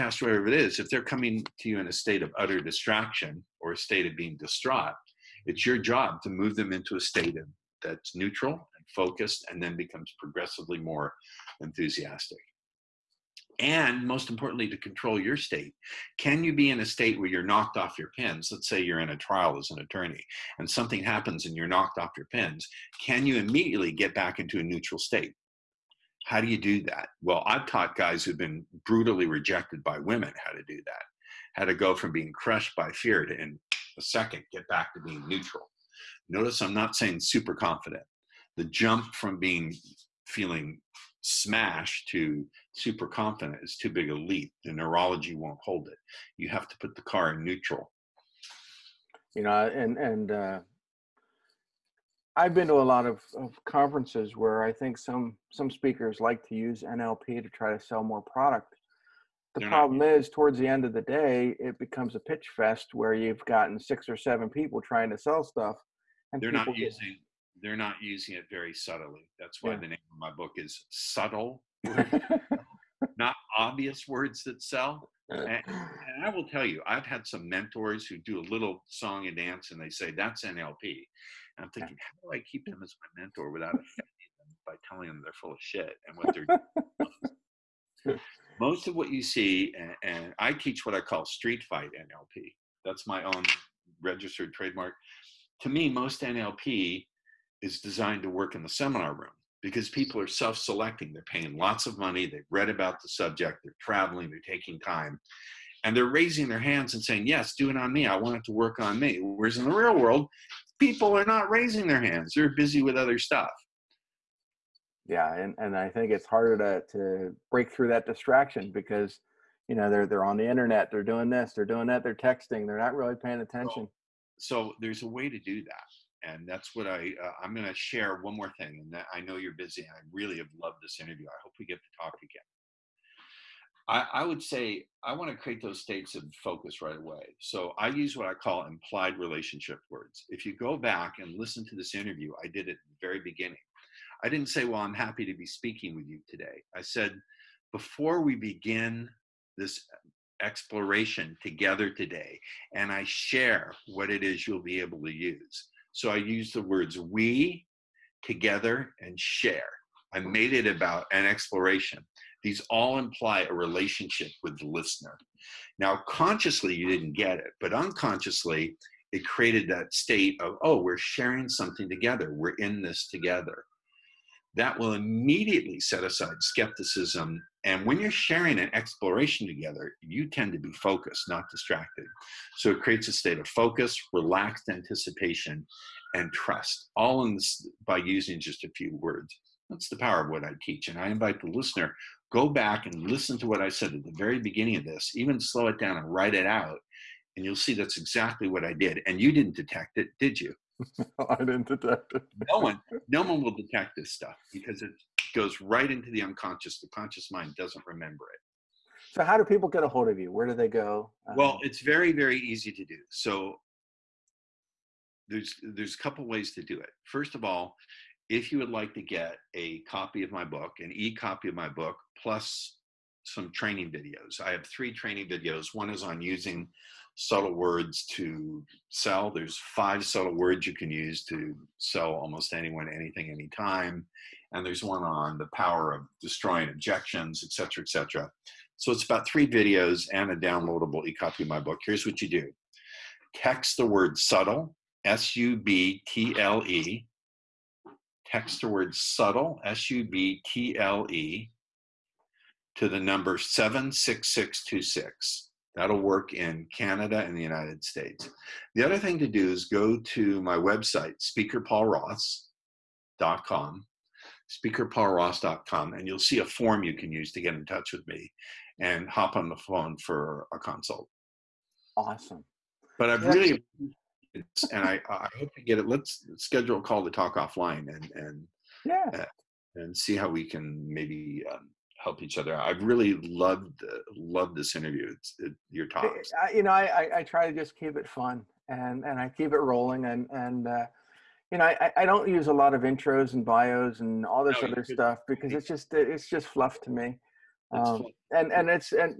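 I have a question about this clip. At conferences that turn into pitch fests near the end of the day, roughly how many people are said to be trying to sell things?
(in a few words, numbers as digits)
6 or 7.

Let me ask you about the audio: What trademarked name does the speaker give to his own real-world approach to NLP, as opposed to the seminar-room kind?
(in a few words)
street fight NLP.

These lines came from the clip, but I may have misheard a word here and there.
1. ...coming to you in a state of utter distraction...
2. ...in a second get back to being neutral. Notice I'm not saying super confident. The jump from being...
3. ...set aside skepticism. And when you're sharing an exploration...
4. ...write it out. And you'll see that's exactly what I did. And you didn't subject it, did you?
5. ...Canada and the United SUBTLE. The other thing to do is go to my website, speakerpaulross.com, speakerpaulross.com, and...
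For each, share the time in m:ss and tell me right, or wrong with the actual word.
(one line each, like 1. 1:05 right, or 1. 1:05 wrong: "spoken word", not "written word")
1. 0:01 right
2. 0:33 right
3. 2:55 right
4. 3:16 wrong: "detect", not "subject"
5. 4:16 wrong: "States", not "SUBTLE".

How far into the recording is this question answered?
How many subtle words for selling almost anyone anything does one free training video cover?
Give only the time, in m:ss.
3:49.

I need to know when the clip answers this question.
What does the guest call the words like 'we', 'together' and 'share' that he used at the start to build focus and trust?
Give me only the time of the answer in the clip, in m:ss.
2:18.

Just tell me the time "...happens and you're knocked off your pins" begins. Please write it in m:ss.
0:21.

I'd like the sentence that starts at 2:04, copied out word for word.
So, so there's a way to do that, and that's what I uh, I'm going to share one more thing.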